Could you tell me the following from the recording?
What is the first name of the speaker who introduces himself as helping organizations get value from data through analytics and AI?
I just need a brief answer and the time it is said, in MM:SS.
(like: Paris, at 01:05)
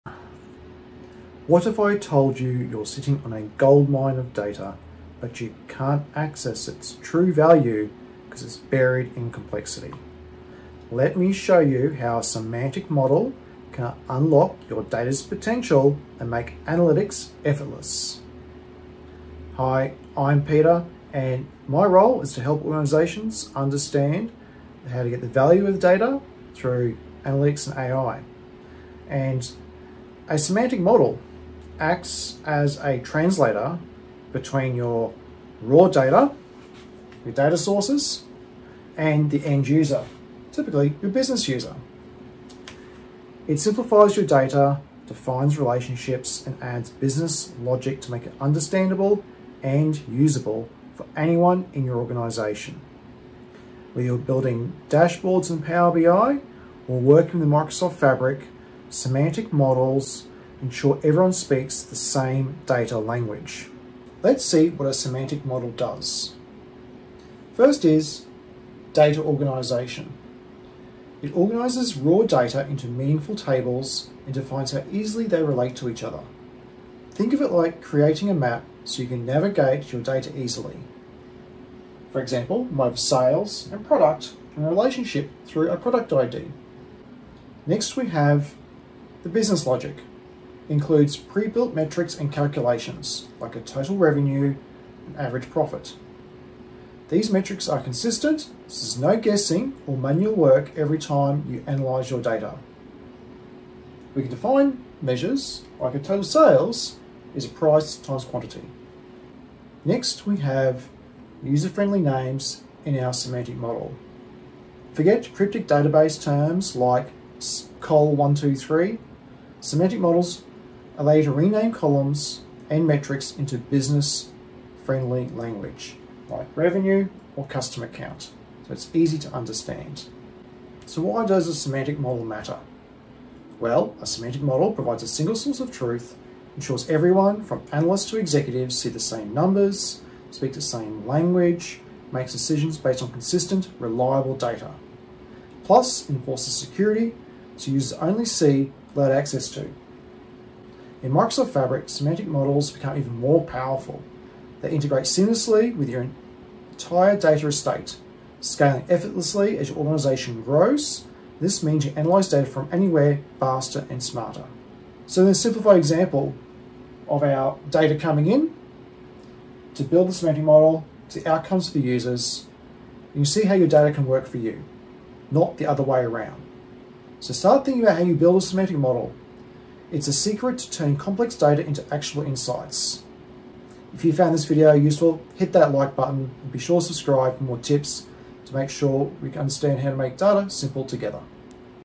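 Peter, at 00:20.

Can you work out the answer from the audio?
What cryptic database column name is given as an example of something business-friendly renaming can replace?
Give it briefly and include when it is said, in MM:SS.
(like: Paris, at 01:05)
col123, at 01:57.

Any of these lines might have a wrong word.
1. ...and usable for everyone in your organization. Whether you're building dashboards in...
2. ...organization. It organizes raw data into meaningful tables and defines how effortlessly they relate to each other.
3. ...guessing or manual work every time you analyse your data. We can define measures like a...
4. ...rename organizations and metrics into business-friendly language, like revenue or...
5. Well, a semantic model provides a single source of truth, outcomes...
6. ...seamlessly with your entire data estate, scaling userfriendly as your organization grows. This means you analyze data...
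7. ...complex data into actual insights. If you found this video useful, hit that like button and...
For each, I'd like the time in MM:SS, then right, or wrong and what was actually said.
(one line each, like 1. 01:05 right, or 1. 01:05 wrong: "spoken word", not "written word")
1. 00:49 wrong: "anyone", not "everyone"
2. 01:09 wrong: "easily", not "effortlessly"
3. 01:39 right
4. 02:01 wrong: "columns", not "organizations"
5. 02:13 wrong: "ensures", not "outcomes"
6. 02:35 wrong: "effortlessly", not "userfriendly"
7. 03:00 right.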